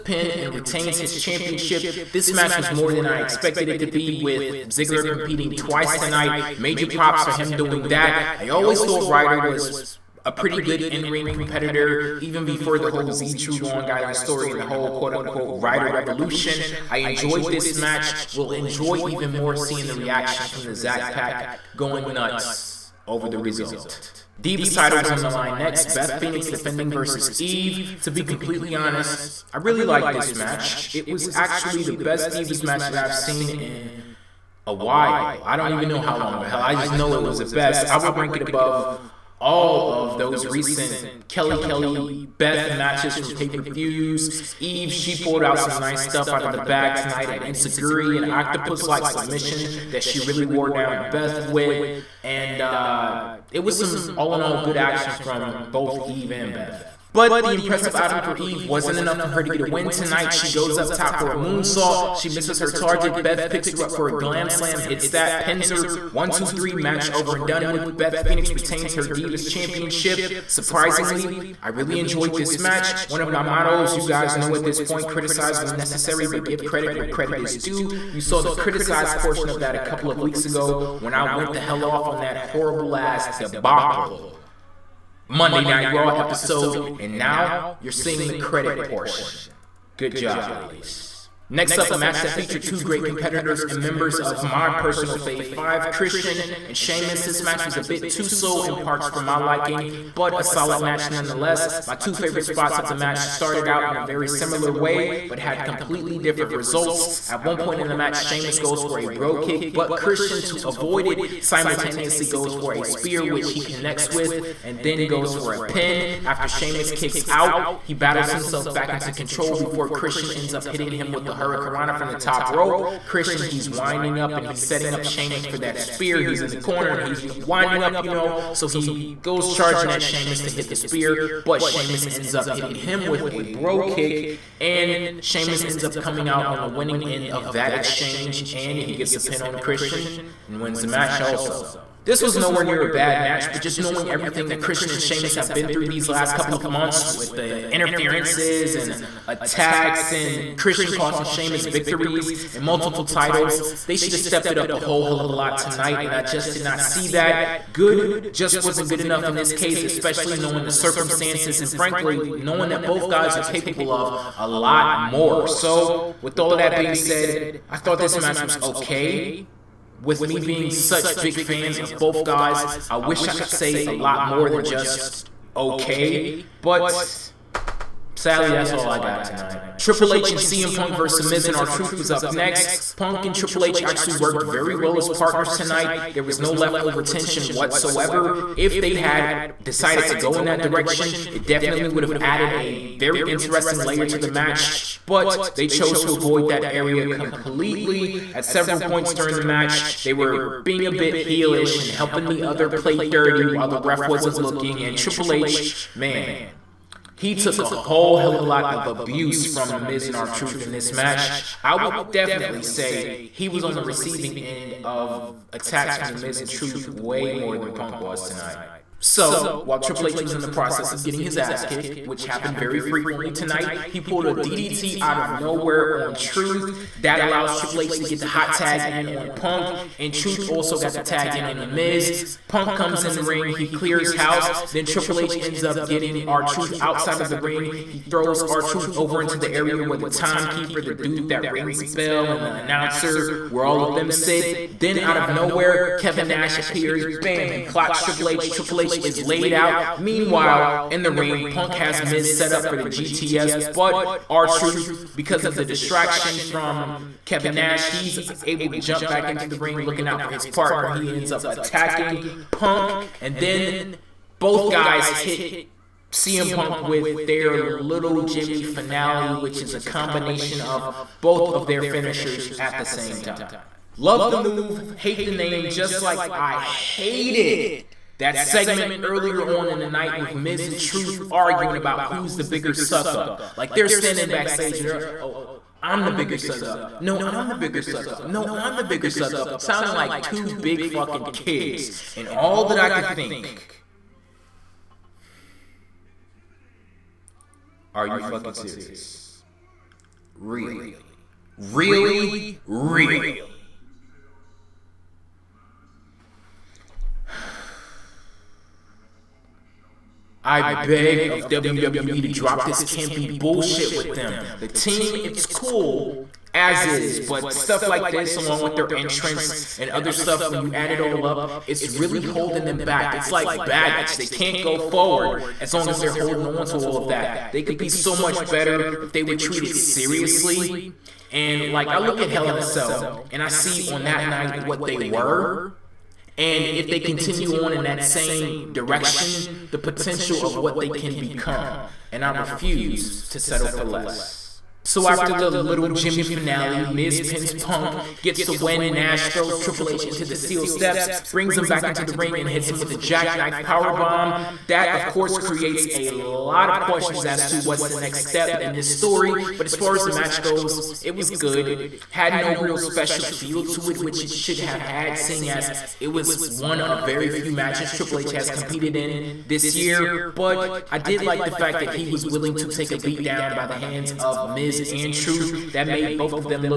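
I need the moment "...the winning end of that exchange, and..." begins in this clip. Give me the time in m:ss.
2:16.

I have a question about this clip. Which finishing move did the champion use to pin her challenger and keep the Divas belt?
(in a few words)
Glam slam.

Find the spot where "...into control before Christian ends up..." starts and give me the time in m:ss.
1:58.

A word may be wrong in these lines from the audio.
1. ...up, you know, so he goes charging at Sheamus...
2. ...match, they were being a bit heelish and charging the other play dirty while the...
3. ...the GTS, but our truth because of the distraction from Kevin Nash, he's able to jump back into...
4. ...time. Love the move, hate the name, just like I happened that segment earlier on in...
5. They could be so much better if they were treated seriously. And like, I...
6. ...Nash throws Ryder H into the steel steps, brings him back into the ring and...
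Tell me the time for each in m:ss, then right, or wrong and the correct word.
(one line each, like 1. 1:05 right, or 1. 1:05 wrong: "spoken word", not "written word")
1. 2:07 right
2. 3:19 wrong: "helping", not "charging"
3. 4:12 right
4. 4:33 wrong: "hated", not "happened"
5. 5:27 right
6. 5:48 wrong: "Triple", not "Ryder".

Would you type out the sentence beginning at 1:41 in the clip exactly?
My two favorite spots of the match started out in a very similar way, but had completely different results.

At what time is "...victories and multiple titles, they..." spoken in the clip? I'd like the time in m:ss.
2:31.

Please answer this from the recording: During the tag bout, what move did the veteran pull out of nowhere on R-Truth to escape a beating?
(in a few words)
DDT.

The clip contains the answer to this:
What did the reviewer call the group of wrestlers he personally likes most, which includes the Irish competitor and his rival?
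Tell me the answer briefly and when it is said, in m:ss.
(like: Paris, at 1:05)
Fave five, at 1:35.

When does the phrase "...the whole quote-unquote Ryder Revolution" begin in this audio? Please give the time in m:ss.
0:14.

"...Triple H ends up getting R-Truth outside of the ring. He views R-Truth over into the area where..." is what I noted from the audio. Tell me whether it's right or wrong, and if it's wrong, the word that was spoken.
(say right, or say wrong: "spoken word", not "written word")
wrong: "throws", not "views".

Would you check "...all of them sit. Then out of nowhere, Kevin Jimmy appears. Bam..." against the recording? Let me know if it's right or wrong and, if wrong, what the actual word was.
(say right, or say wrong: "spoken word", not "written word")
wrong: "Nash", not "Jimmy".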